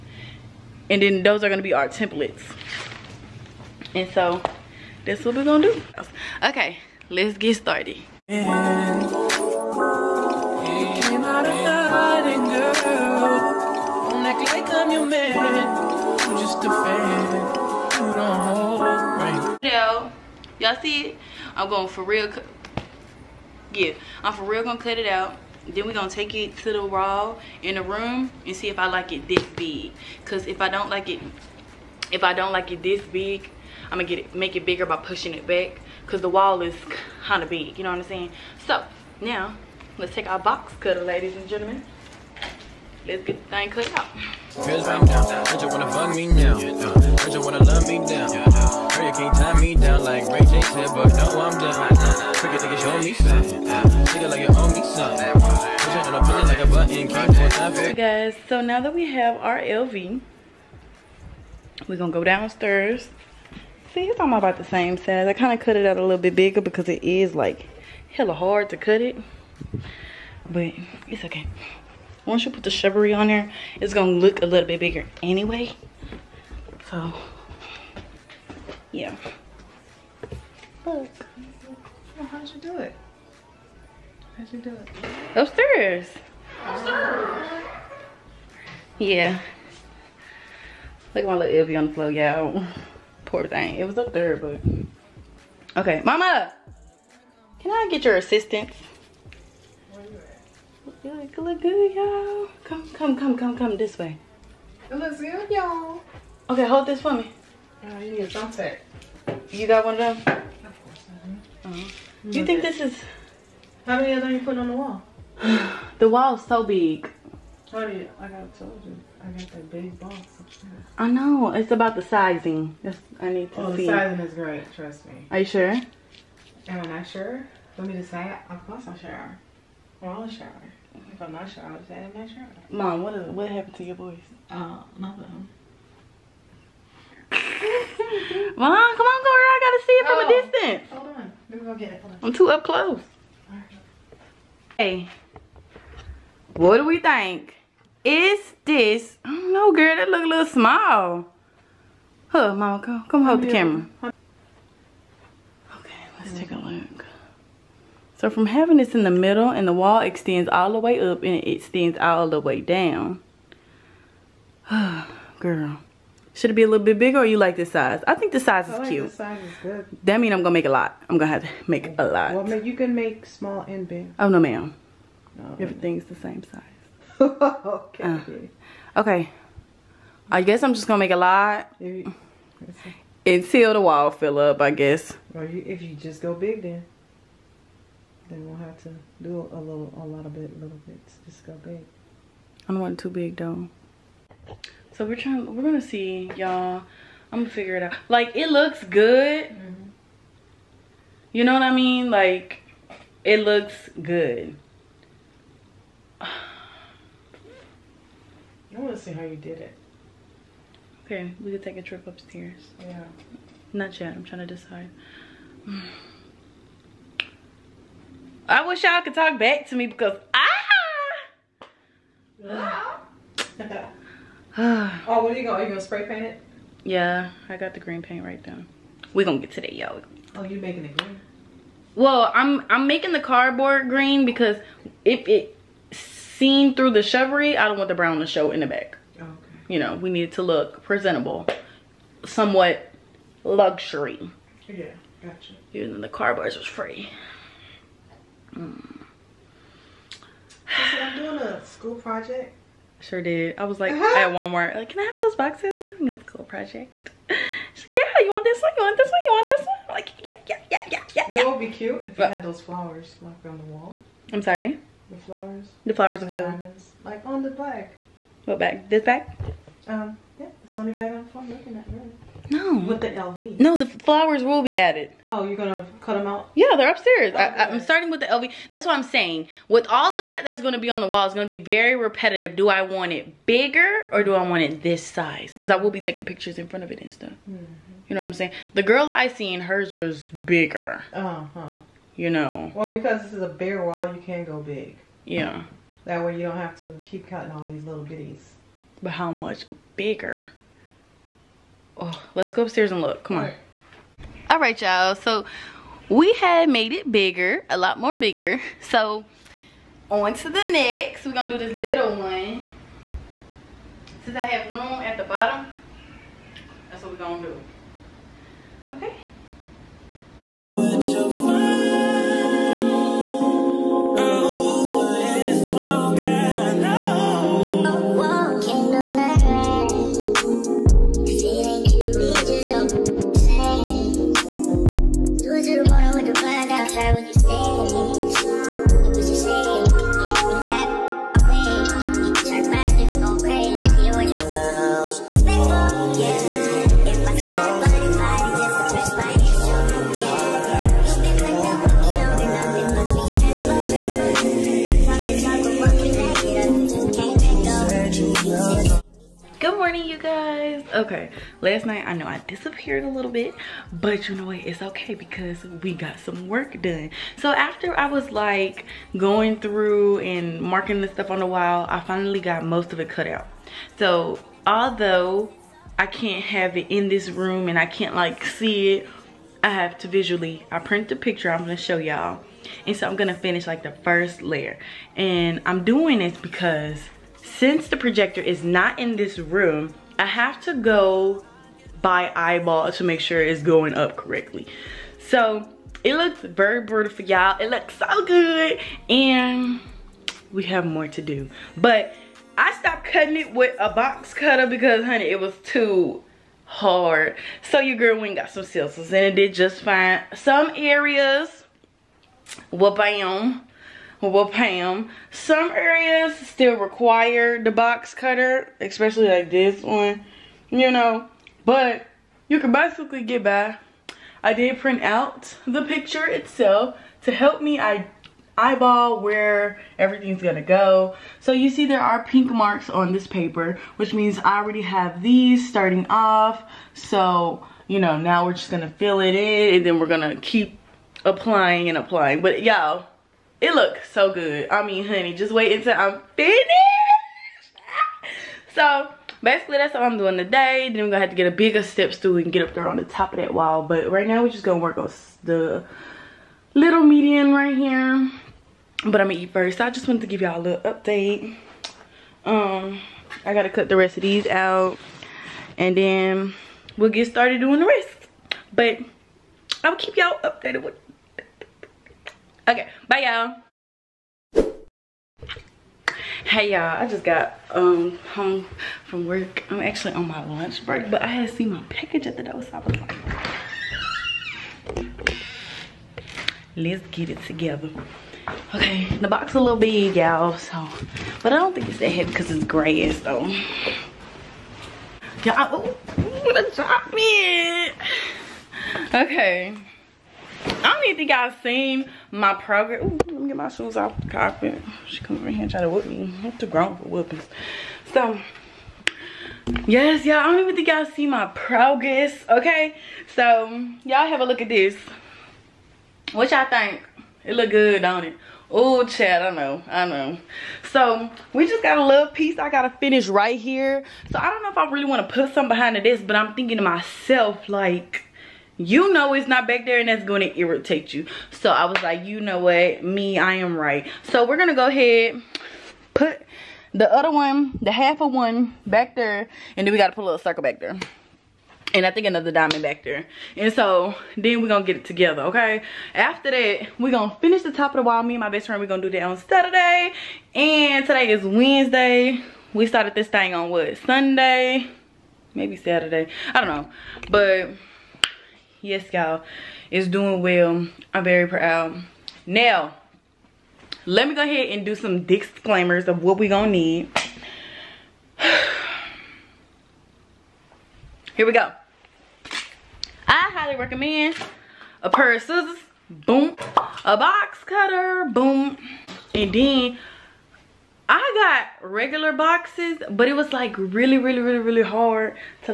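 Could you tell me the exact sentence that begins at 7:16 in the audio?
So, you know, now we're just gonna fill it in and then we're gonna keep applying and applying.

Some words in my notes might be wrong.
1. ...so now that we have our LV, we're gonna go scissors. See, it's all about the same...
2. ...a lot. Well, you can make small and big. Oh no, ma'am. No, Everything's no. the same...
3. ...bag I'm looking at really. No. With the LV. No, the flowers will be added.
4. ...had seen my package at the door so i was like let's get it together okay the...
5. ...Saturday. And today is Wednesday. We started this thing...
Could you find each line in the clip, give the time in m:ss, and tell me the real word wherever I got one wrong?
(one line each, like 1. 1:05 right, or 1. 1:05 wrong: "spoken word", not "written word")
1. 0:58 wrong: "downstairs", not "scissors"
2. 2:51 right
3. 4:30 right
4. 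8:01 right
5. 9:09 right.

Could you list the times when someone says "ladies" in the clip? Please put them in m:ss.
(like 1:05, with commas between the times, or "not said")
0:41.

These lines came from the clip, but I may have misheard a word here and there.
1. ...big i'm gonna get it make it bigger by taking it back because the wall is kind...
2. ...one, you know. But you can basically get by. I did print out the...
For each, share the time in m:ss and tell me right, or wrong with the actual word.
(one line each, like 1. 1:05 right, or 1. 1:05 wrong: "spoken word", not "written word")
1. 0:33 wrong: "pushing", not "taking"
2. 6:59 right.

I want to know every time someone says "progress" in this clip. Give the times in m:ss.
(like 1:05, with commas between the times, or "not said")
8:22, 8:31.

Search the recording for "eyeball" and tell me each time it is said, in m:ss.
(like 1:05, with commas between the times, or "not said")
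6:32, 7:08.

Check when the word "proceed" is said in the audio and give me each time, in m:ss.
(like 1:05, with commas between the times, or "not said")
not said.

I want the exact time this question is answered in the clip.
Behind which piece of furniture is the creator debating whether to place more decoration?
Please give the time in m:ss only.
8:45.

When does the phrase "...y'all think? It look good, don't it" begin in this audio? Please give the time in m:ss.
8:36.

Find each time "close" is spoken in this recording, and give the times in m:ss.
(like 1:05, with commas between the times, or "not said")
2:22.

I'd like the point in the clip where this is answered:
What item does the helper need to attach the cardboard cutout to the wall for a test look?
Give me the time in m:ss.
1:48.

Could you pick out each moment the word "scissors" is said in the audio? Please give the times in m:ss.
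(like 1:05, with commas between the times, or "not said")
6:48, 9:35.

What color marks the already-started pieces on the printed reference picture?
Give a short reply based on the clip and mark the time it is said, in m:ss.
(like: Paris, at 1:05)
pink, at 7:12.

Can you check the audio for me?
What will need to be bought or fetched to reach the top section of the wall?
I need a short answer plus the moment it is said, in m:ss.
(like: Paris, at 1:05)
bigger step stool, at 7:31.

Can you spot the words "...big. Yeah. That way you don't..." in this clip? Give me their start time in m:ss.
4:54.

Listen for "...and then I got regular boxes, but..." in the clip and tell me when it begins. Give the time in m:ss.
9:39.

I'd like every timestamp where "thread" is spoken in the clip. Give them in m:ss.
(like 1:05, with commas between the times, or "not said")
not said.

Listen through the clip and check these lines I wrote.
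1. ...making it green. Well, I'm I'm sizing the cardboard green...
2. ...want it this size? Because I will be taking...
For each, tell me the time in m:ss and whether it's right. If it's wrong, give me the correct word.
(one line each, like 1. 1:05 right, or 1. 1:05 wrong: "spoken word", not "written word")
1. 3:50 wrong: "making", not "sizing"
2. 4:44 right.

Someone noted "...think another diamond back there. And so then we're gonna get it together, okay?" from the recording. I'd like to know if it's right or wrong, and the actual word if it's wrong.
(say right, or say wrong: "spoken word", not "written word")
right.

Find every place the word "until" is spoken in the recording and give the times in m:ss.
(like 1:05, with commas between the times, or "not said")
3:03, 7:25.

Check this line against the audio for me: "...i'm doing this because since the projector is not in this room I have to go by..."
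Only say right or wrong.
right.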